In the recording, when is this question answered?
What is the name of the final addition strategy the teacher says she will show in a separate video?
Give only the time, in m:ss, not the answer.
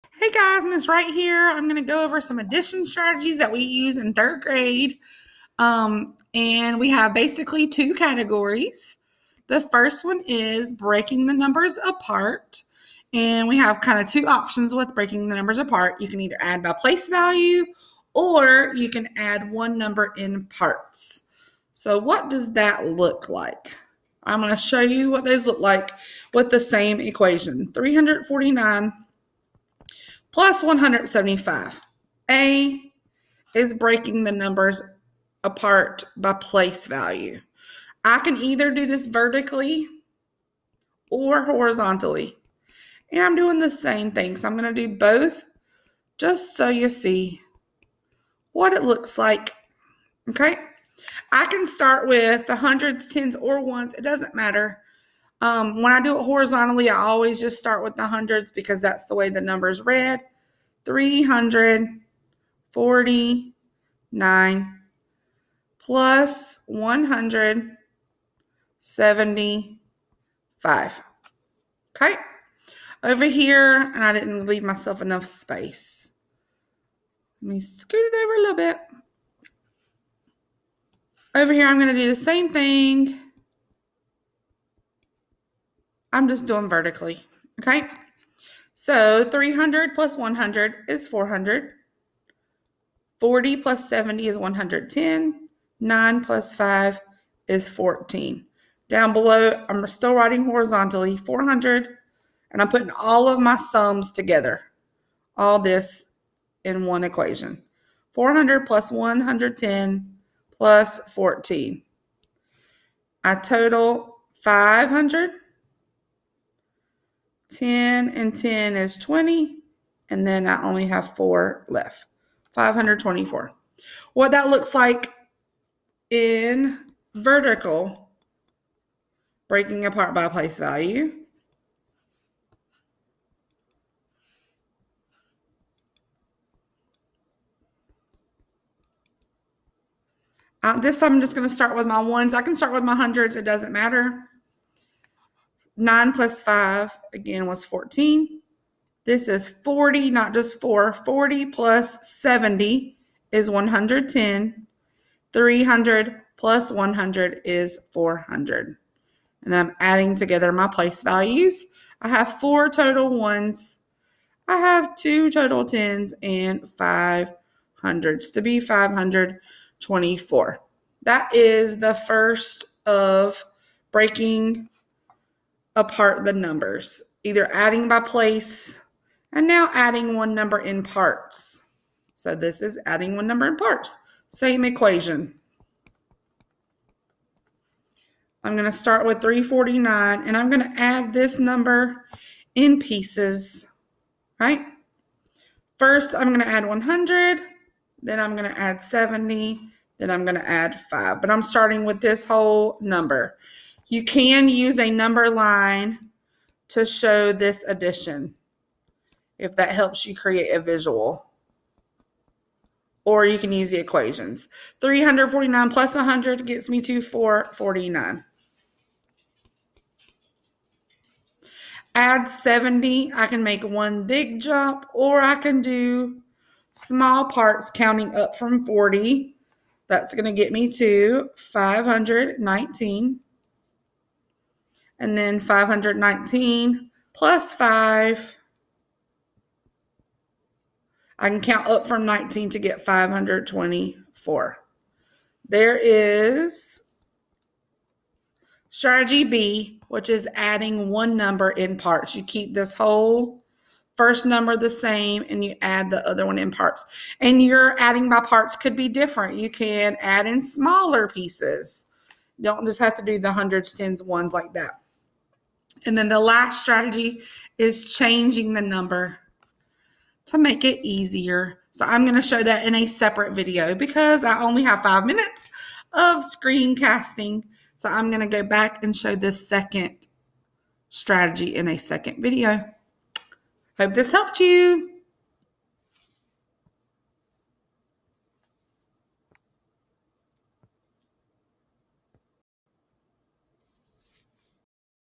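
4:27.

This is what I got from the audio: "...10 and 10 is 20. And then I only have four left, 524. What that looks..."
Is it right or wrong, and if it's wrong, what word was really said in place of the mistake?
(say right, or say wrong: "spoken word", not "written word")
right.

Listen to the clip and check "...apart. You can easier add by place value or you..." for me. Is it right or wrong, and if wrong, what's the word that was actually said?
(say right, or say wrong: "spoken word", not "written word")
wrong: "either", not "easier".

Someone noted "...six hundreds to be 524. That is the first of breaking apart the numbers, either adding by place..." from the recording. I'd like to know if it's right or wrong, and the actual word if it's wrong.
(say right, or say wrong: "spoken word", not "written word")
wrong: "five", not "six".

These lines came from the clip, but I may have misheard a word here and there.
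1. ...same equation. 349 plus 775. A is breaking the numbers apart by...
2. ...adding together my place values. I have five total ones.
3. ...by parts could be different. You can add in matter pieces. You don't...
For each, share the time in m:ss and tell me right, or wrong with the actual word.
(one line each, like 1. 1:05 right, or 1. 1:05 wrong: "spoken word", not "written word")
1. 0:26 wrong: "175", not "775"
2. 2:39 wrong: "four", not "five"
3. 4:18 wrong: "smaller", not "matter".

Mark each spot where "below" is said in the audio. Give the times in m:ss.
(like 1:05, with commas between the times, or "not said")
1:39.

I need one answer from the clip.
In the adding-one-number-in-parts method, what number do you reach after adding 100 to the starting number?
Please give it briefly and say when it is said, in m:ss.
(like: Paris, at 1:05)
449, at 3:37.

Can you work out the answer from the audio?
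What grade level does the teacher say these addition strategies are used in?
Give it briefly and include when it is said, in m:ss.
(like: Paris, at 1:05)
Third grade, at 0:04.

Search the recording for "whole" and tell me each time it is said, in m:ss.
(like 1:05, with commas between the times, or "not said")
3:22, 4:12.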